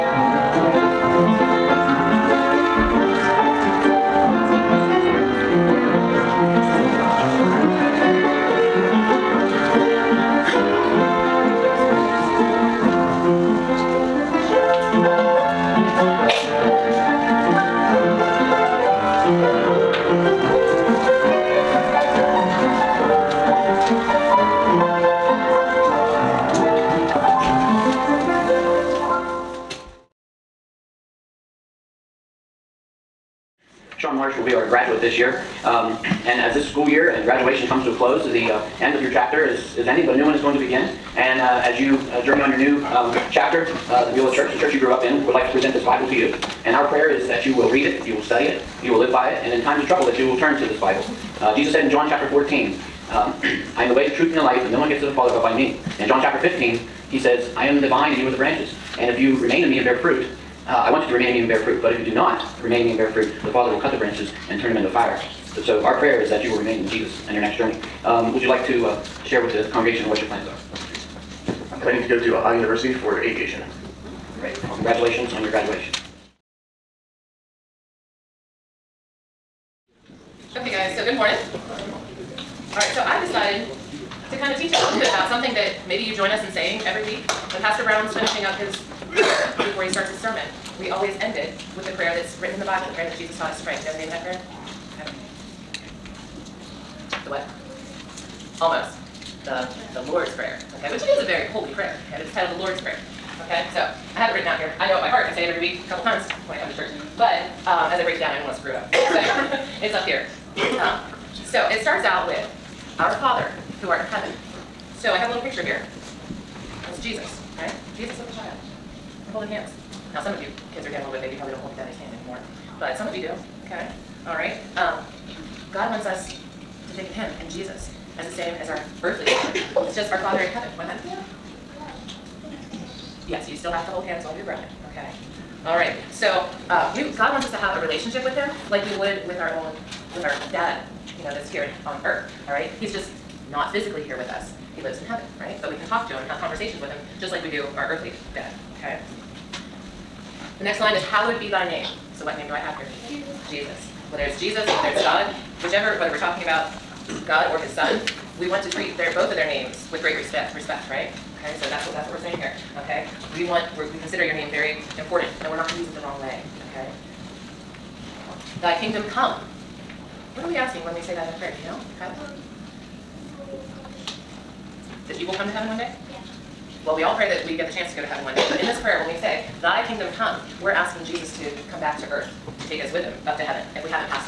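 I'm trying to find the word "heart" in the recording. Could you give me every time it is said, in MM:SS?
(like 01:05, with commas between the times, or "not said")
01:45.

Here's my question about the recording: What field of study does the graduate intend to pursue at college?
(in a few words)
Aviation.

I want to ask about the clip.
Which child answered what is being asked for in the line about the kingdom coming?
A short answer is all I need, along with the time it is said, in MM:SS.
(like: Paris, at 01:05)
Kyla, at 02:51.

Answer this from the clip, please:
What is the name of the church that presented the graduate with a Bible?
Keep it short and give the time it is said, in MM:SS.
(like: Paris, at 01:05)
Beulah Church, at 00:44.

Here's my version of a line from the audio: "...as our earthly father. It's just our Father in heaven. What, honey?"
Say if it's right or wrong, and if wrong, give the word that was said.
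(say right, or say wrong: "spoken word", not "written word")
right.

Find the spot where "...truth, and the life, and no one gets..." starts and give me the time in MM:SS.
00:54.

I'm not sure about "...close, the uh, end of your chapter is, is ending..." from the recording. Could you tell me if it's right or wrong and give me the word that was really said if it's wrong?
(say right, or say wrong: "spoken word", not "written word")
right.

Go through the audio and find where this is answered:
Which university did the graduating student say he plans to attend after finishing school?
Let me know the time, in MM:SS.
01:12.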